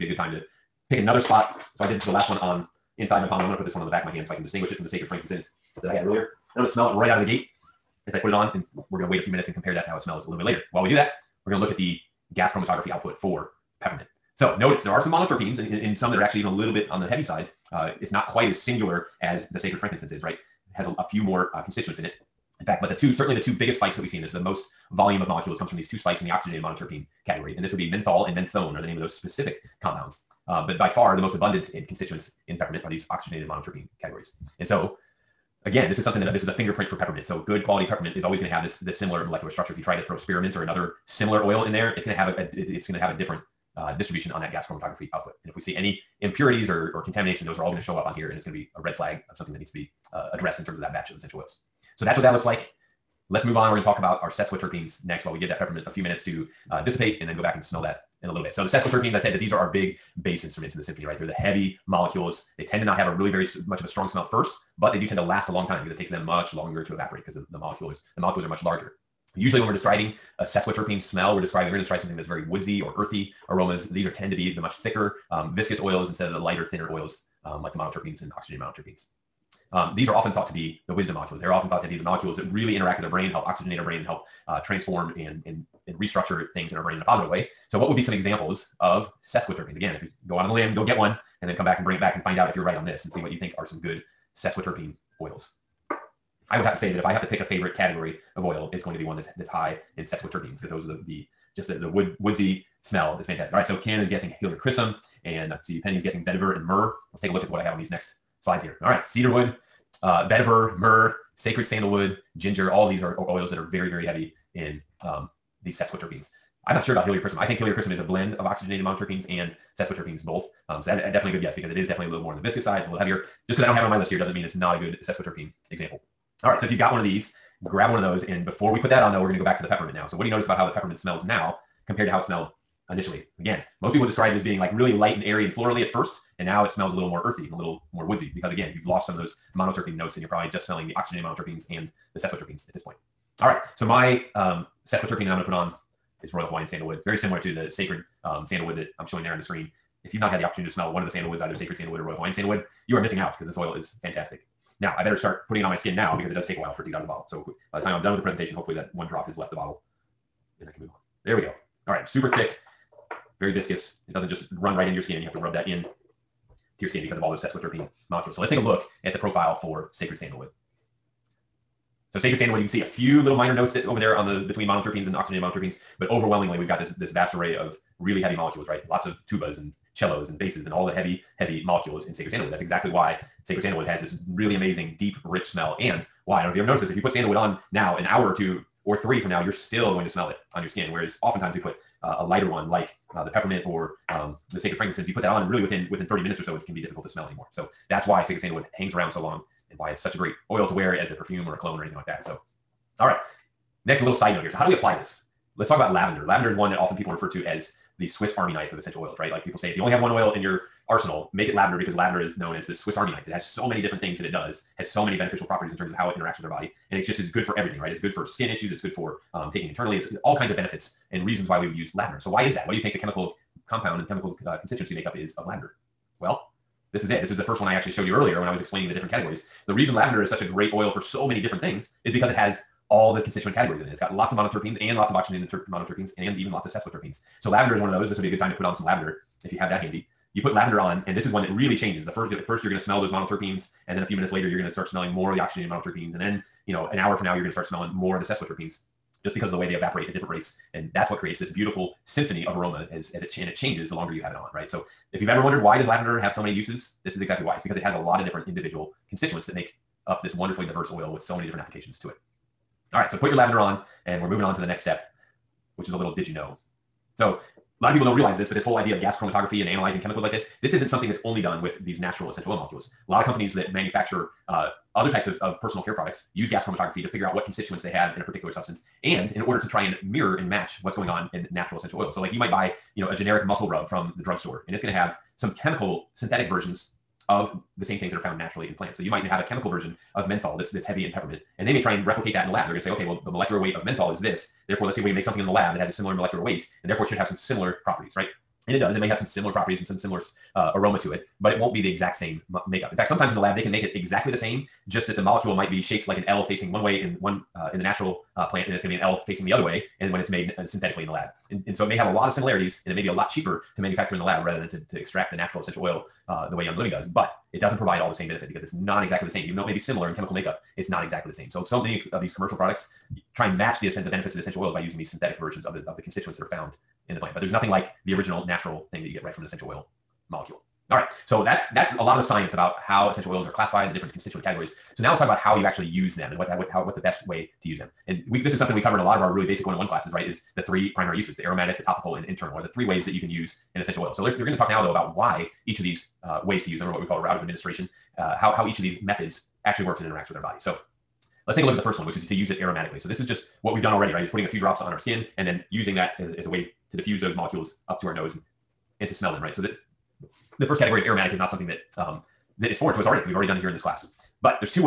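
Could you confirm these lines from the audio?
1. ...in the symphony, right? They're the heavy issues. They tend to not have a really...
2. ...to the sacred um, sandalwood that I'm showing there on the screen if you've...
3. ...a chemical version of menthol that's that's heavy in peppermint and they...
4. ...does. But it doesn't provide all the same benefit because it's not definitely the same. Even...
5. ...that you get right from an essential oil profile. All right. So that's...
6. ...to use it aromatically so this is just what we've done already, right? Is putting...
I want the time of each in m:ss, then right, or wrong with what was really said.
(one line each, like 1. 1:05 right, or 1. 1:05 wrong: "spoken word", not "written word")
1. 1:00 wrong: "molecules", not "issues"
2. 2:27 right
3. 4:49 right
4. 5:16 wrong: "exactly", not "definitely"
5. 5:29 wrong: "molecule", not "profile"
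6. 5:52 right.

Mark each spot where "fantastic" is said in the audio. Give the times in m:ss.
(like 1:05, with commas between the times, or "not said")
1:43, 2:34.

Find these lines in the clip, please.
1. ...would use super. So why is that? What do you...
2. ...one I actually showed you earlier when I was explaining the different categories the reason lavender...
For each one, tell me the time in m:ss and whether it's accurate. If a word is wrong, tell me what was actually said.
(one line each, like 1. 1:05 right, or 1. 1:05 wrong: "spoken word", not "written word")
1. 3:41 wrong: "lavender", not "super"
2. 3:47 right.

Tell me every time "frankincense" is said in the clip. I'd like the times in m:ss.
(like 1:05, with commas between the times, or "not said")
0:05, 0:19, 3:14.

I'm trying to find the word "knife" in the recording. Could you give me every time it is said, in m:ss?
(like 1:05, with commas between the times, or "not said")
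3:28, 3:33.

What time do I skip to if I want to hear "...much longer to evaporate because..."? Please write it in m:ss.
1:06.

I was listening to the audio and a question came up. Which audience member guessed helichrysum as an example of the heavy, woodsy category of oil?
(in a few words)
Ken.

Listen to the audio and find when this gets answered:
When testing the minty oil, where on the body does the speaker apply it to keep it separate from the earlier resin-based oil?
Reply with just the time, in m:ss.
0:03.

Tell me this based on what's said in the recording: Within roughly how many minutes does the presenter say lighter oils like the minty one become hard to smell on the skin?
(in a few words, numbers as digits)
30 minutes.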